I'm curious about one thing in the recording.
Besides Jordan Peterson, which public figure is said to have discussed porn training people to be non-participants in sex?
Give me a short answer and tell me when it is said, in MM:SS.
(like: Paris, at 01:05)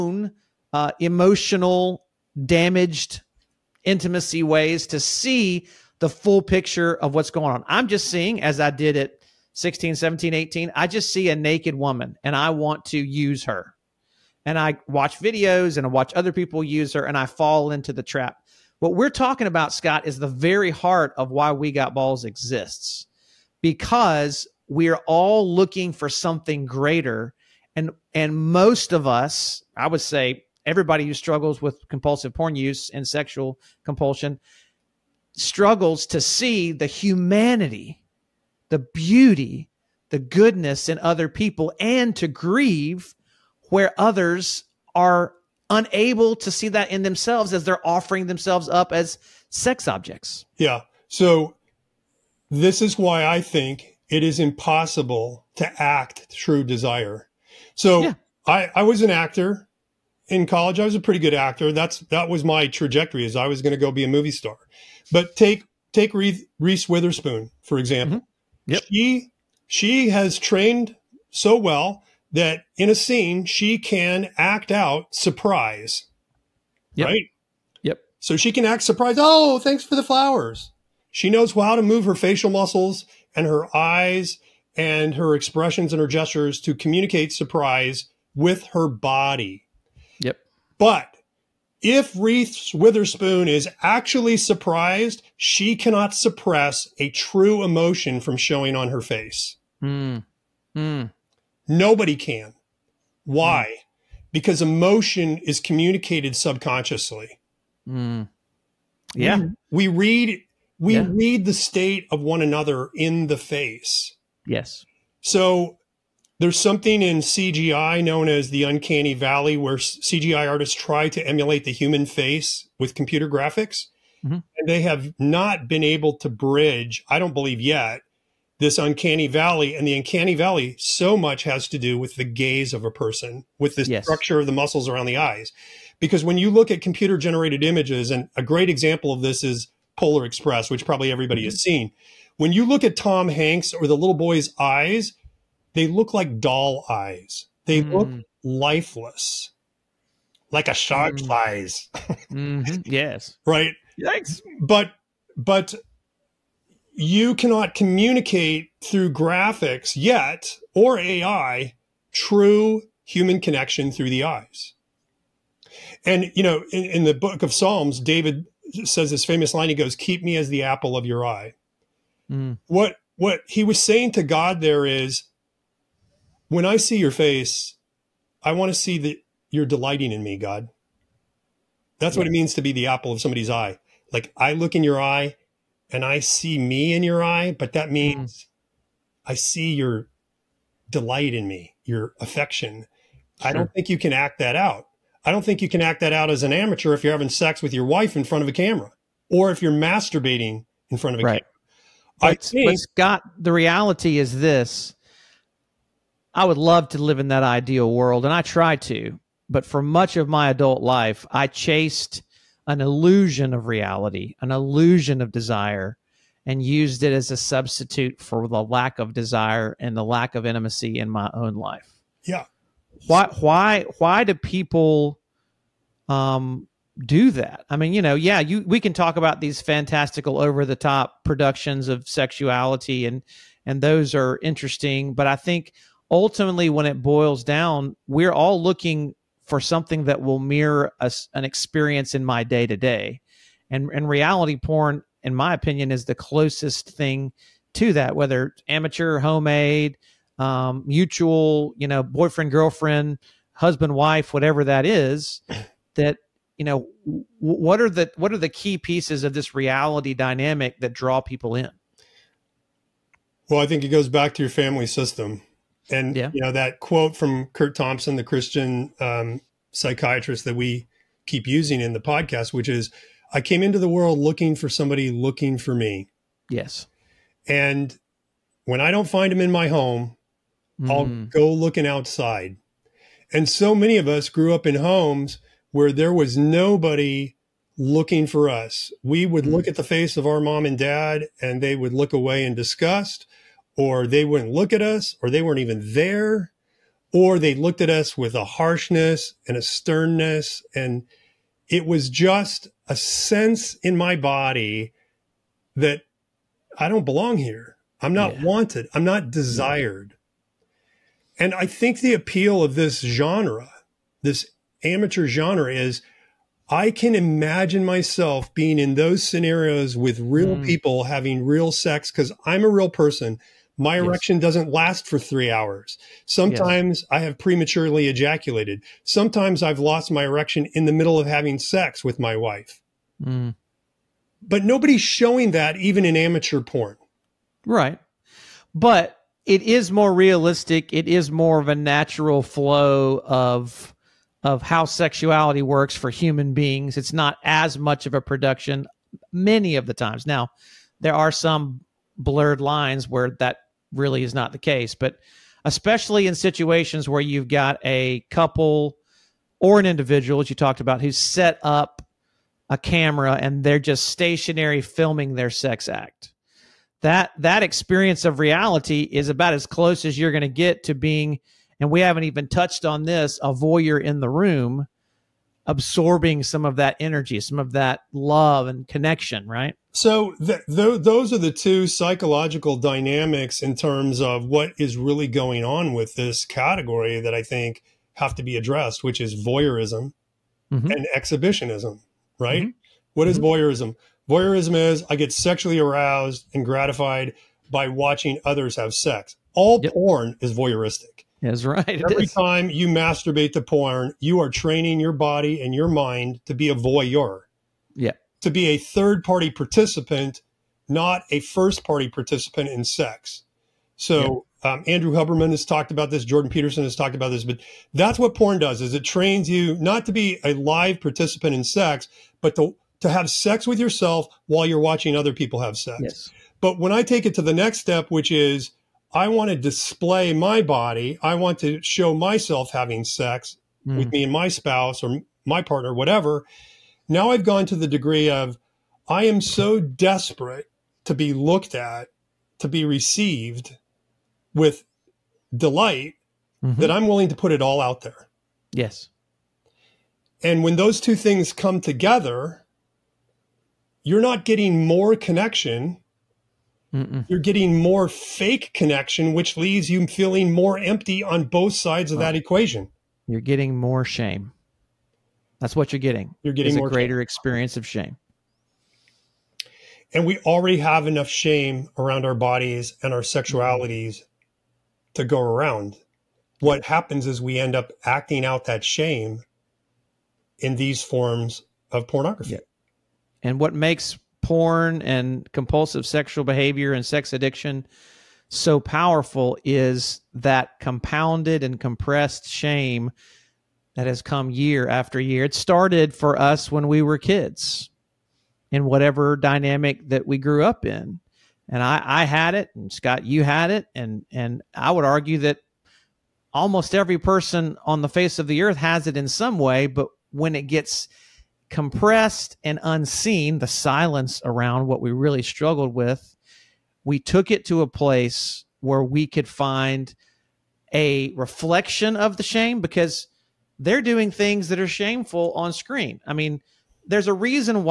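Andrew Huberman, at 06:54.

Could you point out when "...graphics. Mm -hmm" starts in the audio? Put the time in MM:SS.
02:03.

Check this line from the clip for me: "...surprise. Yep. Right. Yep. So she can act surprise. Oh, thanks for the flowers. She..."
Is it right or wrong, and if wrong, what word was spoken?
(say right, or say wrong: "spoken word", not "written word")
right.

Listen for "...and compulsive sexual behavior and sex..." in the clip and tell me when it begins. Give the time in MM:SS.
08:05.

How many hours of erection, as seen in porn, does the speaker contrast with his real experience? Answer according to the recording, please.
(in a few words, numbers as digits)
3.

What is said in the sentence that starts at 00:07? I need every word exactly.
I'm just seeing, as I did at 16, 17, 18, I just see a naked woman and I want to use her.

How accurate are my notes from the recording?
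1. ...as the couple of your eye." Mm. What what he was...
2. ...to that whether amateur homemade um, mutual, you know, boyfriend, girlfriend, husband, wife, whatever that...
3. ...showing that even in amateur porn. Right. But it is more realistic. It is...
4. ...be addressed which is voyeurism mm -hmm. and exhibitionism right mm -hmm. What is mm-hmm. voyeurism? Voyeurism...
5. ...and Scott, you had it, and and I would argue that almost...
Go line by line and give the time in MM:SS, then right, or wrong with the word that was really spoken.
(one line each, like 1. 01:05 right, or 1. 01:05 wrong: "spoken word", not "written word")
1. 02:50 wrong: "apple", not "couple"
2. 04:07 right
3. 05:35 right
4. 06:28 right
5. 08:22 right.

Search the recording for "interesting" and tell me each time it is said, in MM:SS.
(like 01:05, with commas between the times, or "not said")
03:54.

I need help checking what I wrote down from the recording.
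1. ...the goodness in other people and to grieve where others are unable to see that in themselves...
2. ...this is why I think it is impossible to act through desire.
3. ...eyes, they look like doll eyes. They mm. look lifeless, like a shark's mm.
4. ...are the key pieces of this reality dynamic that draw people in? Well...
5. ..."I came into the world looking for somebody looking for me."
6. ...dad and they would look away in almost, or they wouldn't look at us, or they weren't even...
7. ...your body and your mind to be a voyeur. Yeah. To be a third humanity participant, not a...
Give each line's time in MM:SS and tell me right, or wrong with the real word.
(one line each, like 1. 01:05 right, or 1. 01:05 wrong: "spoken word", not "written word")
1. 00:40 right
2. 00:52 right
3. 02:24 right
4. 04:18 right
5. 04:33 right
6. 04:50 wrong: "disgust", not "almost"
7. 06:44 wrong: "party", not "humanity".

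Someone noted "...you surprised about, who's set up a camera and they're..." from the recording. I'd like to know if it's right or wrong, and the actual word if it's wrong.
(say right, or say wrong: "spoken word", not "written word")
wrong: "talked", not "surprised".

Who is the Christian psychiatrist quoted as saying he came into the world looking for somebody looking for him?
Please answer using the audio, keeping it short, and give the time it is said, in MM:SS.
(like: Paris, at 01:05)
Kurt Thompson, at 04:27.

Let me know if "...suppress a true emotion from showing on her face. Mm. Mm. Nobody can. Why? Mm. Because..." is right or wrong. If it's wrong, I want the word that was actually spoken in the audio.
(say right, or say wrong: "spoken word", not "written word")
right.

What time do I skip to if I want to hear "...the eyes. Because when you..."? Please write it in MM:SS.
02:15.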